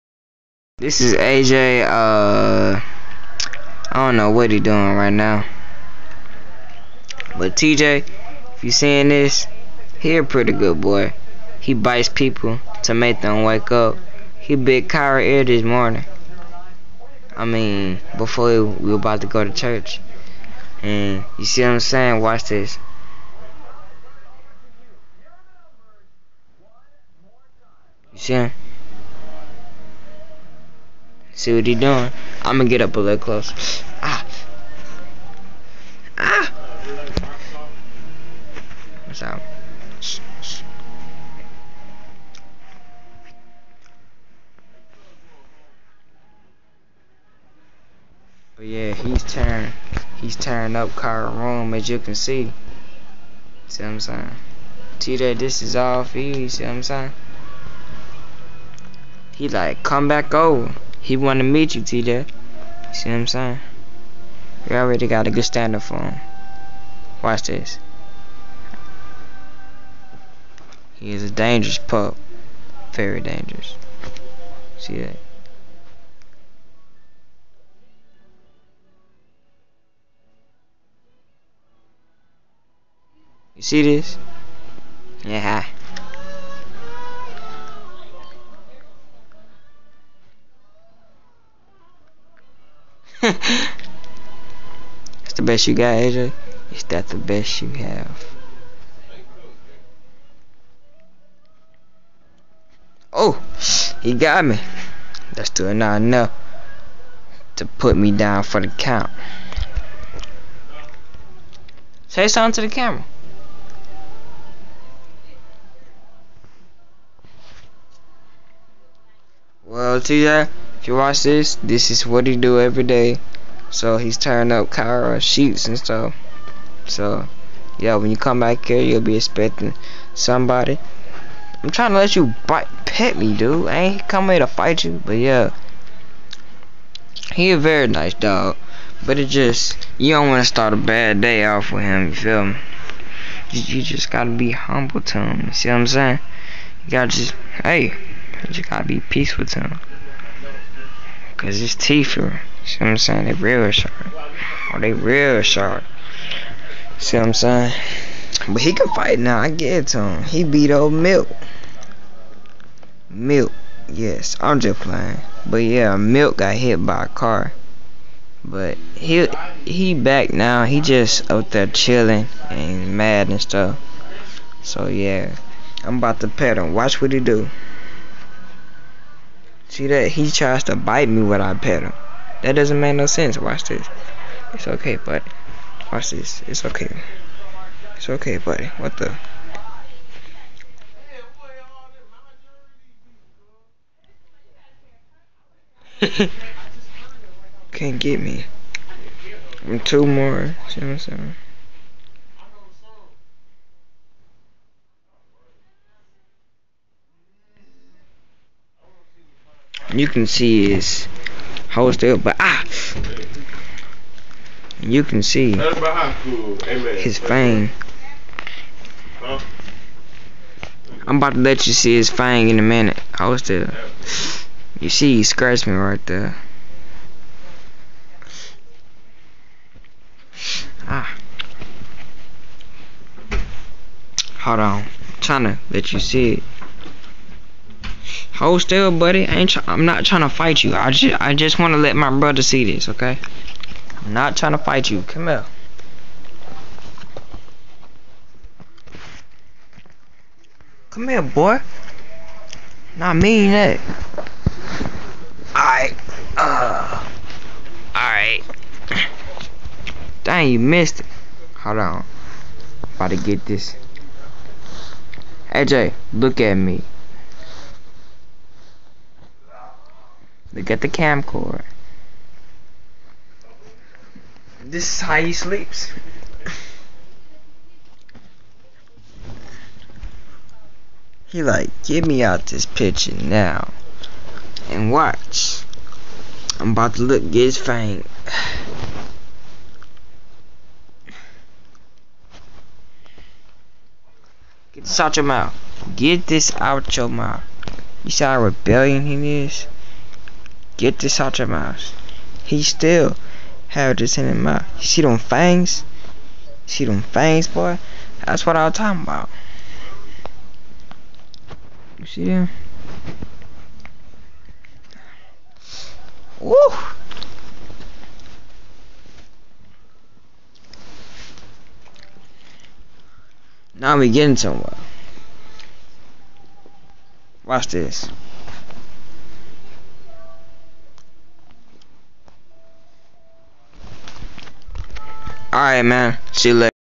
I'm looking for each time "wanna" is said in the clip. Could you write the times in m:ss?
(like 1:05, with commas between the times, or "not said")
1:01.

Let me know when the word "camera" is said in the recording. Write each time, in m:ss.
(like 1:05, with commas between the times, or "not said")
1:52.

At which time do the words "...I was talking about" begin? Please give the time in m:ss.
5:08.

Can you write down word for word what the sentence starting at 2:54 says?
So yeah, I'm about to pet him.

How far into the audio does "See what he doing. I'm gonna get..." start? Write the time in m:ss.
0:31.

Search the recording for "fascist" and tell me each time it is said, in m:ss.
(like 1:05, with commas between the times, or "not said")
not said.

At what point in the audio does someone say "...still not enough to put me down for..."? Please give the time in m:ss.
1:45.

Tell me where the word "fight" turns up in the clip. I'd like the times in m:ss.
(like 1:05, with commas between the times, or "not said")
2:14, 2:38, 4:00, 4:04.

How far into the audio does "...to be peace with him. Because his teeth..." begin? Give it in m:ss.
2:28.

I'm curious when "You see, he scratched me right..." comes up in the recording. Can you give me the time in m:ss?
3:44.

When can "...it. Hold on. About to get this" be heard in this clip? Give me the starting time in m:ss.
4:21.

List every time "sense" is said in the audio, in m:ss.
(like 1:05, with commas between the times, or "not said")
3:03.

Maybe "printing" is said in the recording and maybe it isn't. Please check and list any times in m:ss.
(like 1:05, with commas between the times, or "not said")
not said.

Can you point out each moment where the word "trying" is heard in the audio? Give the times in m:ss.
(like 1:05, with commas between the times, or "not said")
2:11, 3:55, 4:00, 4:04.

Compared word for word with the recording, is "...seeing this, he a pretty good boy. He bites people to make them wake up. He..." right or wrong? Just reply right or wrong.
right.